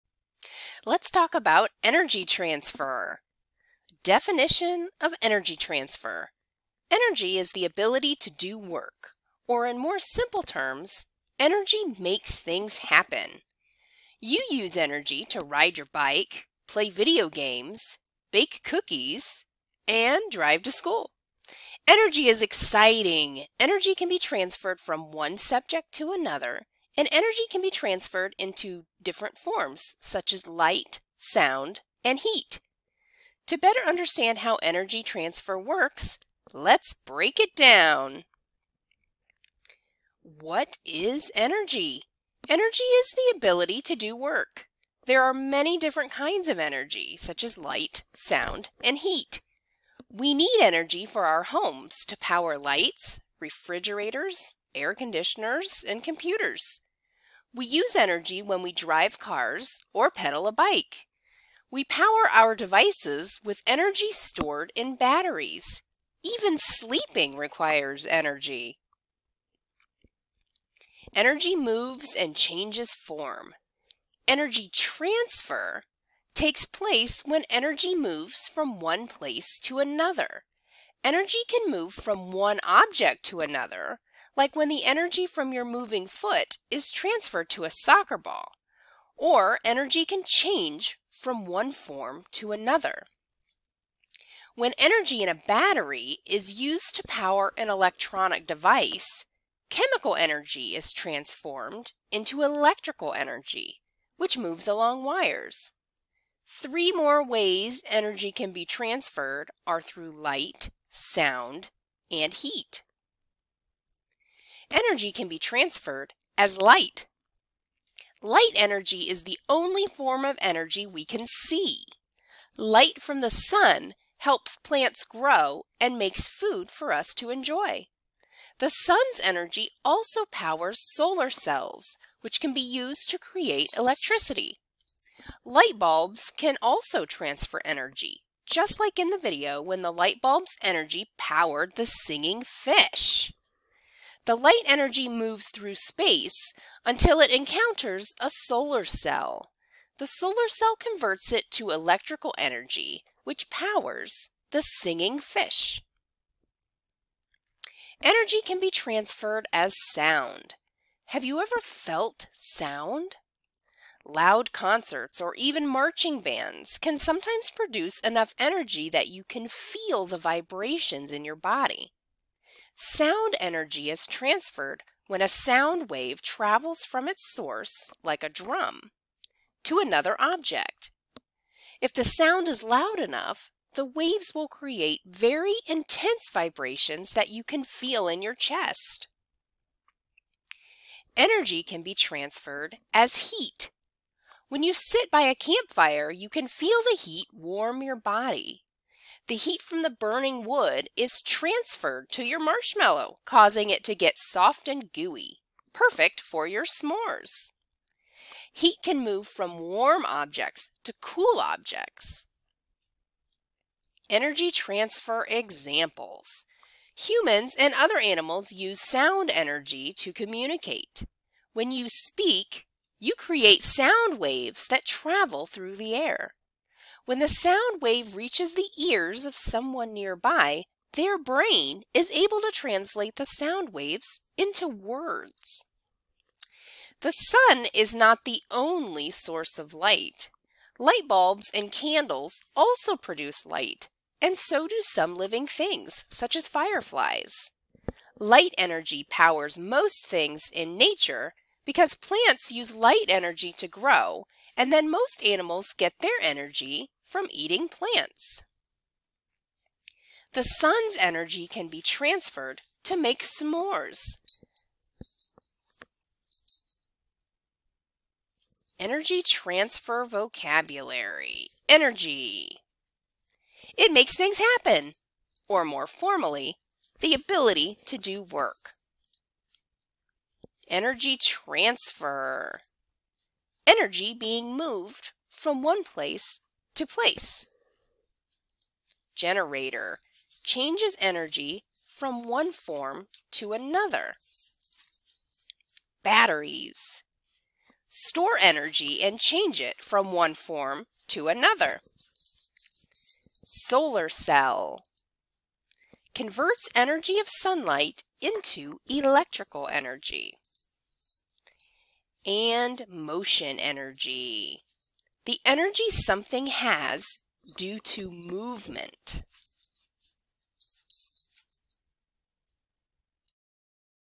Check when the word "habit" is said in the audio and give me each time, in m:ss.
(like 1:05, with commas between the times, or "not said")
not said.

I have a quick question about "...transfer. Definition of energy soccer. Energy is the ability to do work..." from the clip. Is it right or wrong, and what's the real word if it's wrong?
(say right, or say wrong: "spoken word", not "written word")
wrong: "transfer", not "soccer".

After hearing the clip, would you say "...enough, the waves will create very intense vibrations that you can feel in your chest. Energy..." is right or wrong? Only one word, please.
right.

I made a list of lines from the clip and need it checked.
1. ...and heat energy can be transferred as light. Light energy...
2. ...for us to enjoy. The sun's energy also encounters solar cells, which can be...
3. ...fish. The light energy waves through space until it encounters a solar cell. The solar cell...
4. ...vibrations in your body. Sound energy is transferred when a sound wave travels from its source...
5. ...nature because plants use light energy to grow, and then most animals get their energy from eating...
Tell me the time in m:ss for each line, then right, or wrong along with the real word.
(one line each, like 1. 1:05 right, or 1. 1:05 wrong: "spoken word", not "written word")
1. 1:52 right
2. 2:06 wrong: "powers", not "encounters"
3. 2:22 wrong: "moves", not "waves"
4. 2:50 right
5. 4:10 right.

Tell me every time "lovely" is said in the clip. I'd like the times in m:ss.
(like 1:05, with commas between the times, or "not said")
not said.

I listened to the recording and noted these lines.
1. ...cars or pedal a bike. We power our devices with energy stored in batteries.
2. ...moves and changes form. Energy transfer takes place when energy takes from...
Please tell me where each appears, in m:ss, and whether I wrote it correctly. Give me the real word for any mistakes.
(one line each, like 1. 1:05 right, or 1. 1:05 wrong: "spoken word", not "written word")
1. 0:59 right
2. 1:11 wrong: "moves", not "takes".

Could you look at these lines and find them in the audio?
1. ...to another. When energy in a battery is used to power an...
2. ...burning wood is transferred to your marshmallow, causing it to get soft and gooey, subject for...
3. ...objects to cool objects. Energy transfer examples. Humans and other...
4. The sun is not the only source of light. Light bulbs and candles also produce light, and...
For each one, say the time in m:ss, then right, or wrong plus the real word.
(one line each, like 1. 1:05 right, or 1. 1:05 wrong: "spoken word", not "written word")
1. 1:32 right
2. 3:19 wrong: "perfect", not "subject"
3. 3:30 right
4. 3:57 right.